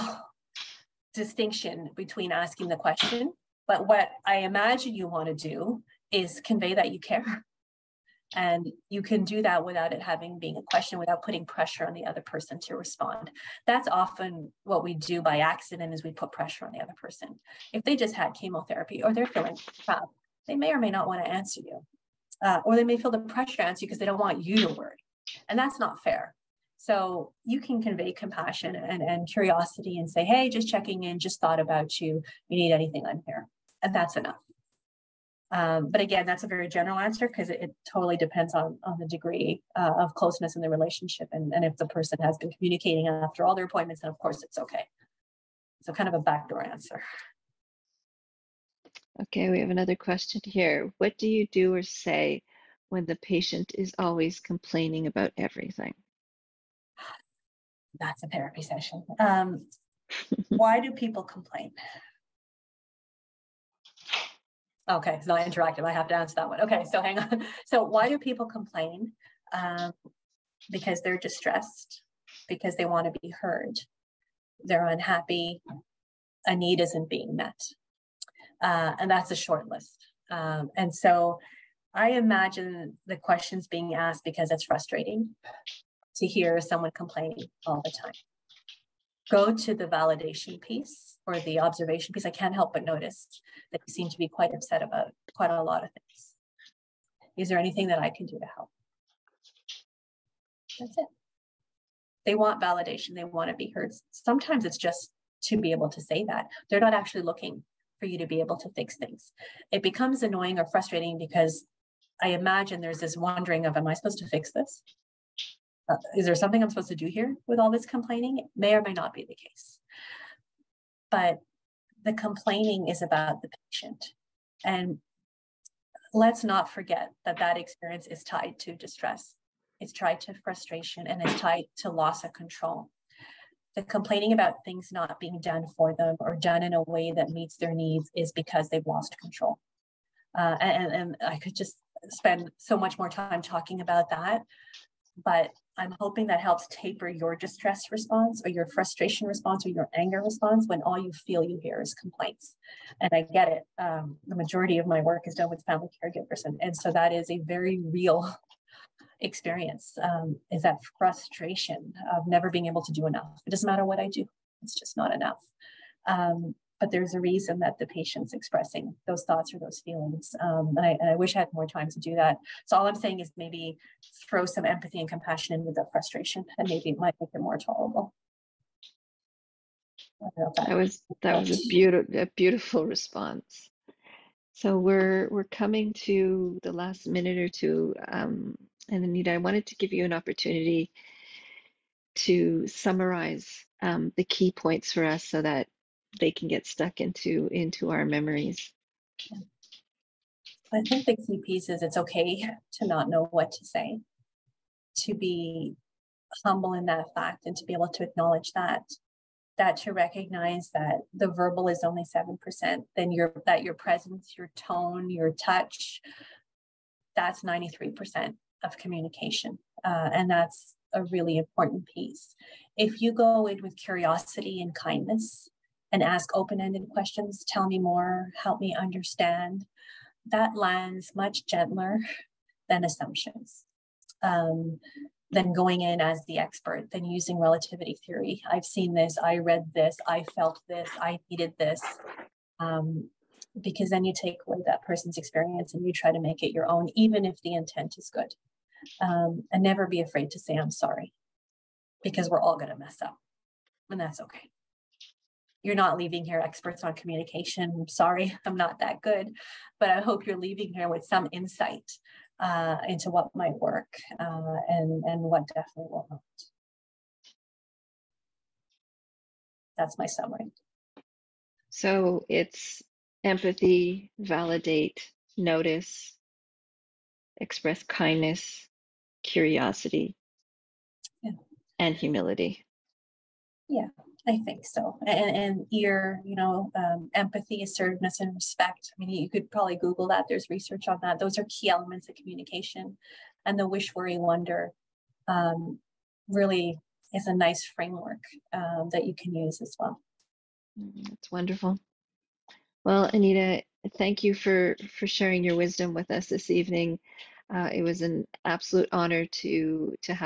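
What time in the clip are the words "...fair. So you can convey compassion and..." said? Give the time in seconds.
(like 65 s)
26 s.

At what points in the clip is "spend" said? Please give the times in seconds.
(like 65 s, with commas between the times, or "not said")
142 s.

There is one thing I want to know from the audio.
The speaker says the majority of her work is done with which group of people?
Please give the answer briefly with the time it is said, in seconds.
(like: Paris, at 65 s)
family caregivers, at 155 s.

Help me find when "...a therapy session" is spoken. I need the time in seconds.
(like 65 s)
58 s.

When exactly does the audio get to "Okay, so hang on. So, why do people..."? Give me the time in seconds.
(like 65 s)
66 s.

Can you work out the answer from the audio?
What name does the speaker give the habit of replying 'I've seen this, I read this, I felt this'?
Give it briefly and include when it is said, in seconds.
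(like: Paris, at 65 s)
relativity theory, at 237 s.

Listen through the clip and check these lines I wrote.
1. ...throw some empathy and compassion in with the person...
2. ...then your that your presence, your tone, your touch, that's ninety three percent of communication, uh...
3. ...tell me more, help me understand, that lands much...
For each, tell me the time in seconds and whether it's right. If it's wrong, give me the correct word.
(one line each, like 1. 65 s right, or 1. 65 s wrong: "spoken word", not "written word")
1. 174 s wrong: "frustration", not "person"
2. 212 s right
3. 227 s right.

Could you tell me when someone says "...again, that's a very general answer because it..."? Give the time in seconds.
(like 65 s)
36 s.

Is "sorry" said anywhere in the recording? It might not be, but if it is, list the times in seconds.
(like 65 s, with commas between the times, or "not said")
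250 s, 257 s.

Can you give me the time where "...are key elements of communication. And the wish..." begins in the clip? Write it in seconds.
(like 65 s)
291 s.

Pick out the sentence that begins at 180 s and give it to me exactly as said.
That was that was a beautiful a beautiful response.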